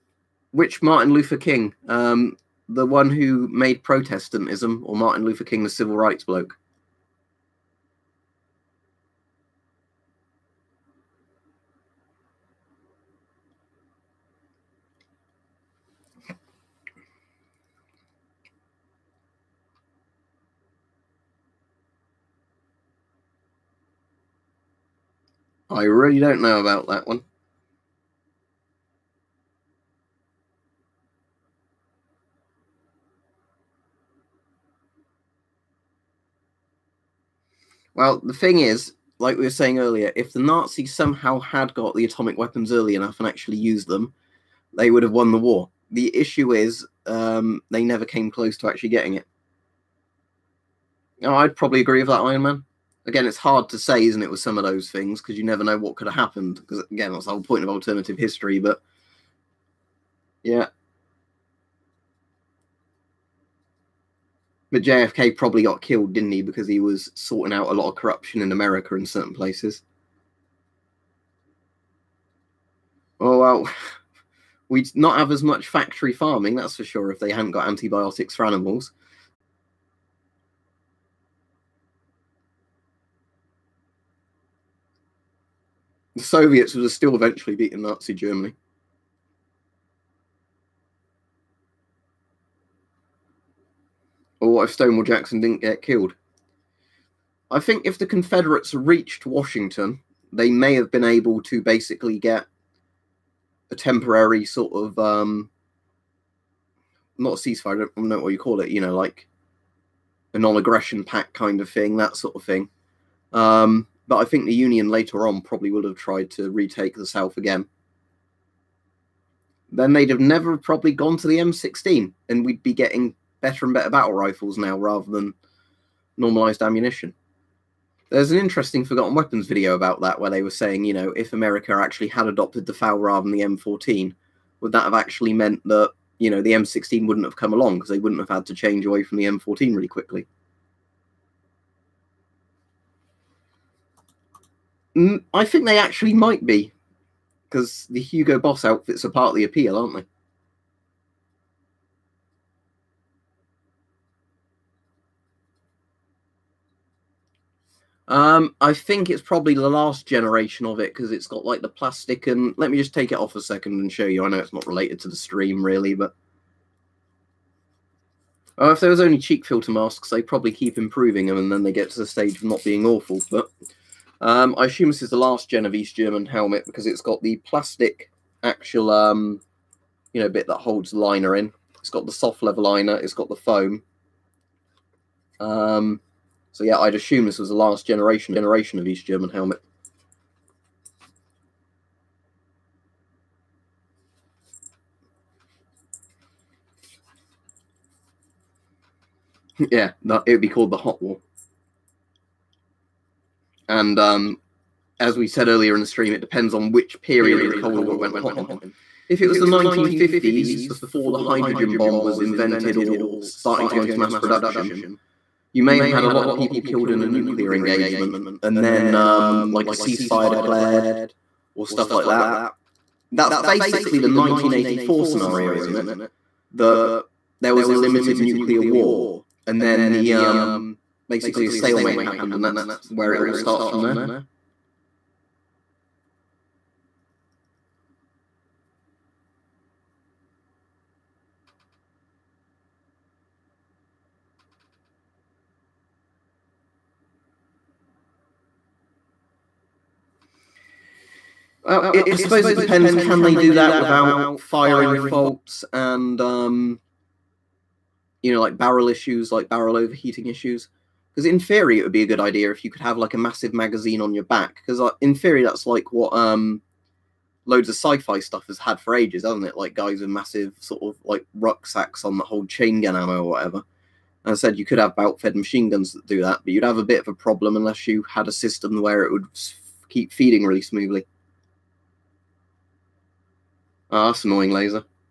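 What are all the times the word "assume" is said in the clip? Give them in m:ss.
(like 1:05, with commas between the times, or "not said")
2:54, 3:06.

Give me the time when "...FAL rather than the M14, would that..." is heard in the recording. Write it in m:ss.
2:12.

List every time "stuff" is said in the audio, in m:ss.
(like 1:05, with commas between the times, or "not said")
3:41, 4:28.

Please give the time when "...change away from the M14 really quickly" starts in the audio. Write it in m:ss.
2:18.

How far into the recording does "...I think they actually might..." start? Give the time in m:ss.
2:25.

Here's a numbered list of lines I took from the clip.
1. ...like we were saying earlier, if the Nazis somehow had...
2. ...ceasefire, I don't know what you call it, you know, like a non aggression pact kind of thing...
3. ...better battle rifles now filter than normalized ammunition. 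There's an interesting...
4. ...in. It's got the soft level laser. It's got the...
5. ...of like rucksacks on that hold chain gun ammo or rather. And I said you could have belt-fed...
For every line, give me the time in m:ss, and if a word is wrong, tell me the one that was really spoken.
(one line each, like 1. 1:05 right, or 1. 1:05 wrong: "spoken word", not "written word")
1. 0:39 right
2. 1:47 right
3. 2:03 wrong: "rather", not "filter"
4. 3:01 wrong: "liner", not "laser"
5. 4:30 wrong: "whatever", not "rather".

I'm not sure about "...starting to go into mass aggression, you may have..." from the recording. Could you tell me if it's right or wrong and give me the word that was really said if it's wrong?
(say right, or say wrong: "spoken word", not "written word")
wrong: "production", not "aggression".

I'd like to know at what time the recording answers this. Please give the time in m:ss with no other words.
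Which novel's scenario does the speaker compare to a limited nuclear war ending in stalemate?
3:44.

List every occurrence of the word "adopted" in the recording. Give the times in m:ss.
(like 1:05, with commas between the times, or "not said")
2:12.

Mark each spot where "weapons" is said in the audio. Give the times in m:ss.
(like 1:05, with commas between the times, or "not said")
0:42, 2:09.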